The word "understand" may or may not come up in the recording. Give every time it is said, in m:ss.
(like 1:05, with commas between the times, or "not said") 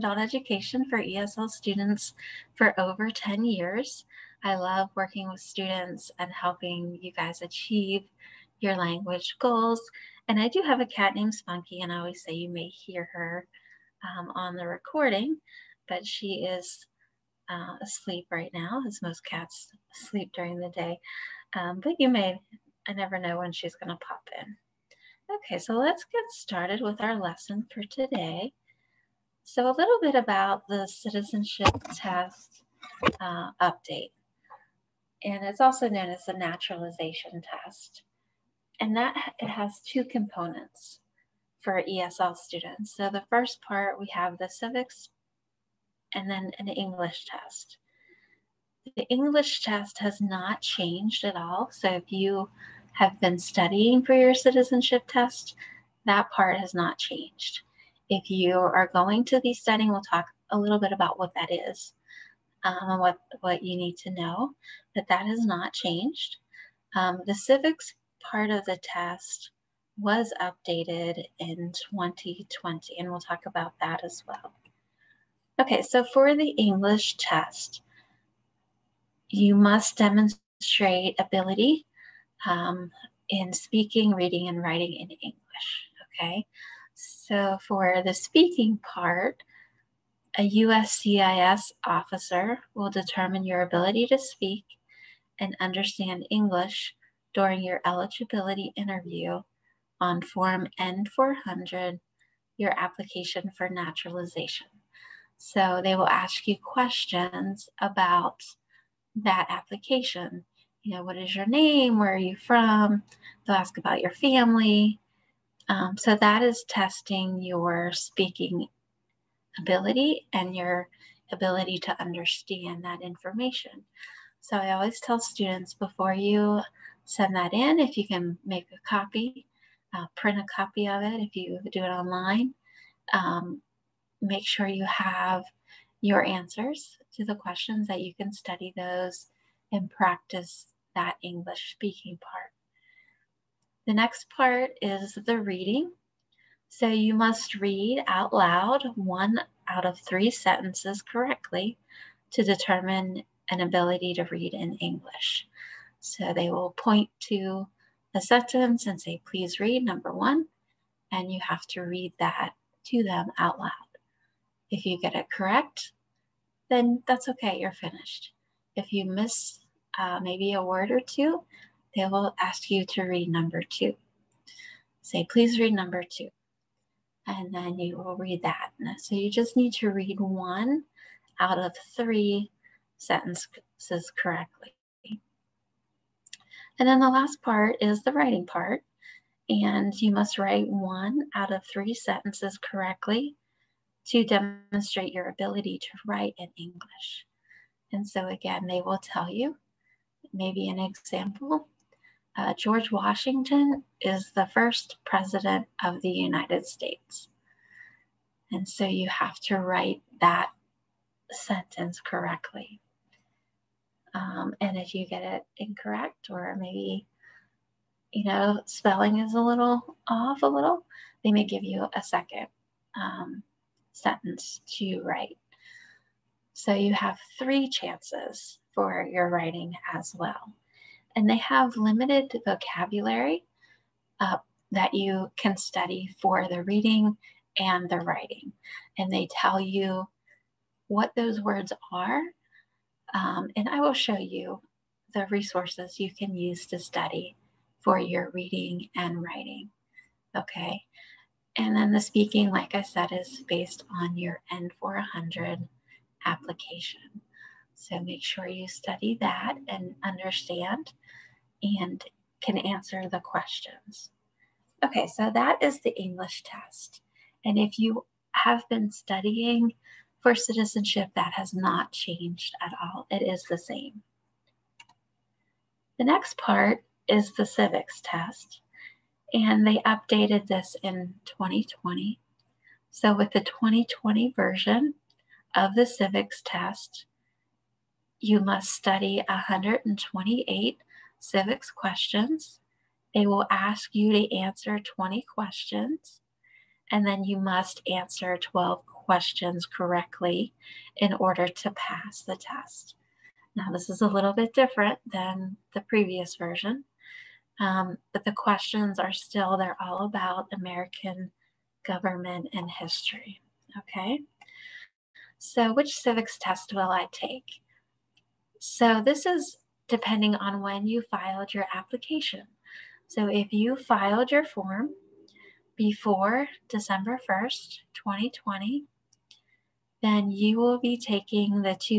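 1:35, 2:02, 4:20.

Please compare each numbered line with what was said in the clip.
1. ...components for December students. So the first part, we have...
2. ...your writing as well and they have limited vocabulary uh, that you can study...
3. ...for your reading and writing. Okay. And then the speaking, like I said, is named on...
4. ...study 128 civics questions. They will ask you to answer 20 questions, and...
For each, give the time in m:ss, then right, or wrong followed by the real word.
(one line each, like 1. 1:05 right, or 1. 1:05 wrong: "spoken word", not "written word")
1. 0:40 wrong: "ESL", not "December"
2. 3:49 right
3. 4:07 wrong: "based", not "named"
4. 4:48 right.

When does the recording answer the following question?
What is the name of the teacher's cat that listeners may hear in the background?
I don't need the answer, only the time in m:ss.
0:11.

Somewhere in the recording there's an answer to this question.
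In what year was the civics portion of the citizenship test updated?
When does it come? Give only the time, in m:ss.
1:10.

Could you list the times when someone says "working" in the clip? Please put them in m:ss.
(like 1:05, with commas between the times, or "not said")
0:04.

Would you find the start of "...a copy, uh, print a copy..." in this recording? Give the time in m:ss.
2:08.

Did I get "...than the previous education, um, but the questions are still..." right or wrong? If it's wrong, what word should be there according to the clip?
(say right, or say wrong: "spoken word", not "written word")
wrong: "version", not "education".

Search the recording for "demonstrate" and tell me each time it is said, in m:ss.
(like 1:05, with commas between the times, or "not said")
1:19, 3:14.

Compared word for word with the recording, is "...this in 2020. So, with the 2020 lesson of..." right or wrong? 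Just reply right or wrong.
wrong.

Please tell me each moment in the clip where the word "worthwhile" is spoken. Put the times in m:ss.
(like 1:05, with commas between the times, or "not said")
not said.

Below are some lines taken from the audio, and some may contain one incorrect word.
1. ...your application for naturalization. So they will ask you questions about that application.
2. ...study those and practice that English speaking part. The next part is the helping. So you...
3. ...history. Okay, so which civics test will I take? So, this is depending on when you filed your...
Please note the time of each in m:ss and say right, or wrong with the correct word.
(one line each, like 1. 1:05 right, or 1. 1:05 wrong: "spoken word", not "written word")
1. 1:42 right
2. 2:18 wrong: "reading", not "helping"
3. 5:12 right.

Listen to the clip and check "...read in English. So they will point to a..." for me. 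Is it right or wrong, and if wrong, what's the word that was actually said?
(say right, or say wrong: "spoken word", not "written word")
right.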